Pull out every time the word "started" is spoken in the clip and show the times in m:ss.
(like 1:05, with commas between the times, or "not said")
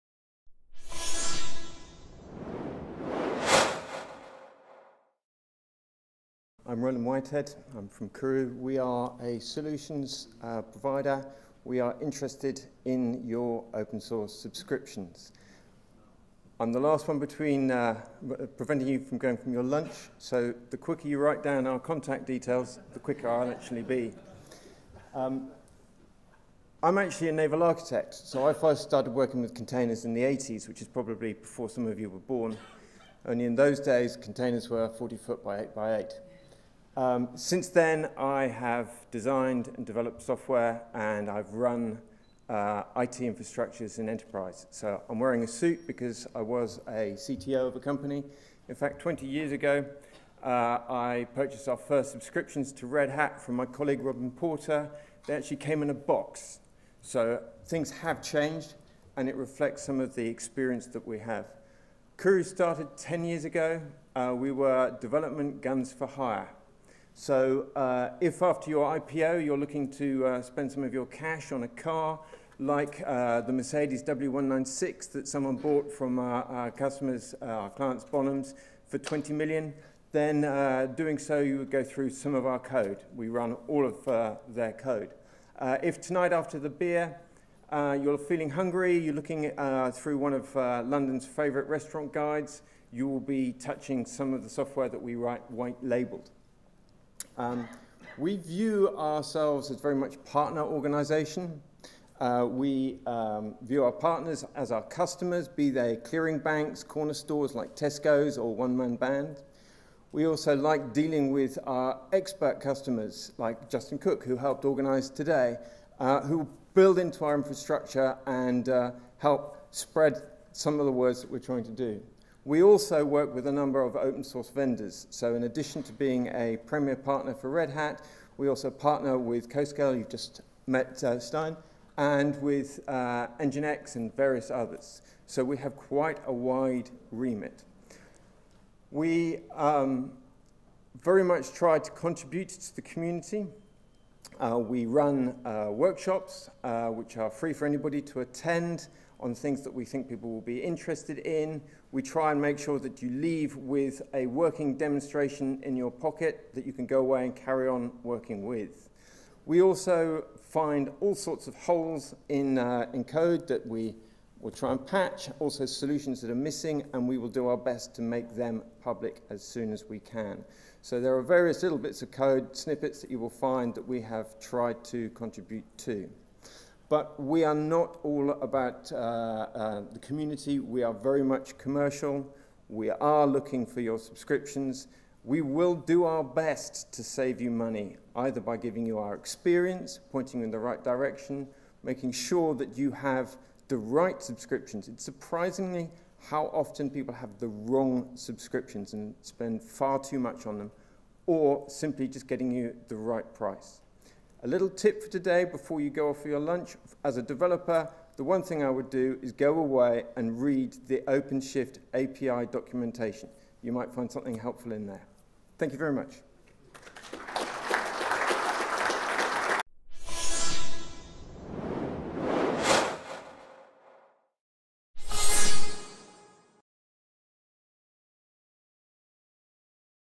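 0:28, 1:02.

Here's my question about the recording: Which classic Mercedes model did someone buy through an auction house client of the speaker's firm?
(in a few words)
W196.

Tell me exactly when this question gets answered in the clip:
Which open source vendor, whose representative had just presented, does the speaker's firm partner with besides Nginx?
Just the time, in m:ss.
2:09.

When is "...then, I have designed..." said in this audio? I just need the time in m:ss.
0:37.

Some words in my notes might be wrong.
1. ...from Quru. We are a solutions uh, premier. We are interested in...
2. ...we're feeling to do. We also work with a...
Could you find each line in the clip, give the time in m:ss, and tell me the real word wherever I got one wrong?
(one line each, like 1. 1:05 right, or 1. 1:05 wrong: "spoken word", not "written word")
1. 0:07 wrong: "provider", not "premier"
2. 2:01 wrong: "trying", not "feeling".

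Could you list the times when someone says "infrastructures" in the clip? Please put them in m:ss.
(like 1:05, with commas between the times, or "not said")
0:43, 1:57.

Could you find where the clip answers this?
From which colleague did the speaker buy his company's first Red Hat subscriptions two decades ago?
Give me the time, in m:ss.
0:54.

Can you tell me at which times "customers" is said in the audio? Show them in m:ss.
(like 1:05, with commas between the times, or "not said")
1:16, 1:44, 1:52.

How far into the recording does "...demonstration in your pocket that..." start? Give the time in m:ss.
2:34.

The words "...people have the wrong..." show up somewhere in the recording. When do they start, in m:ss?
3:16.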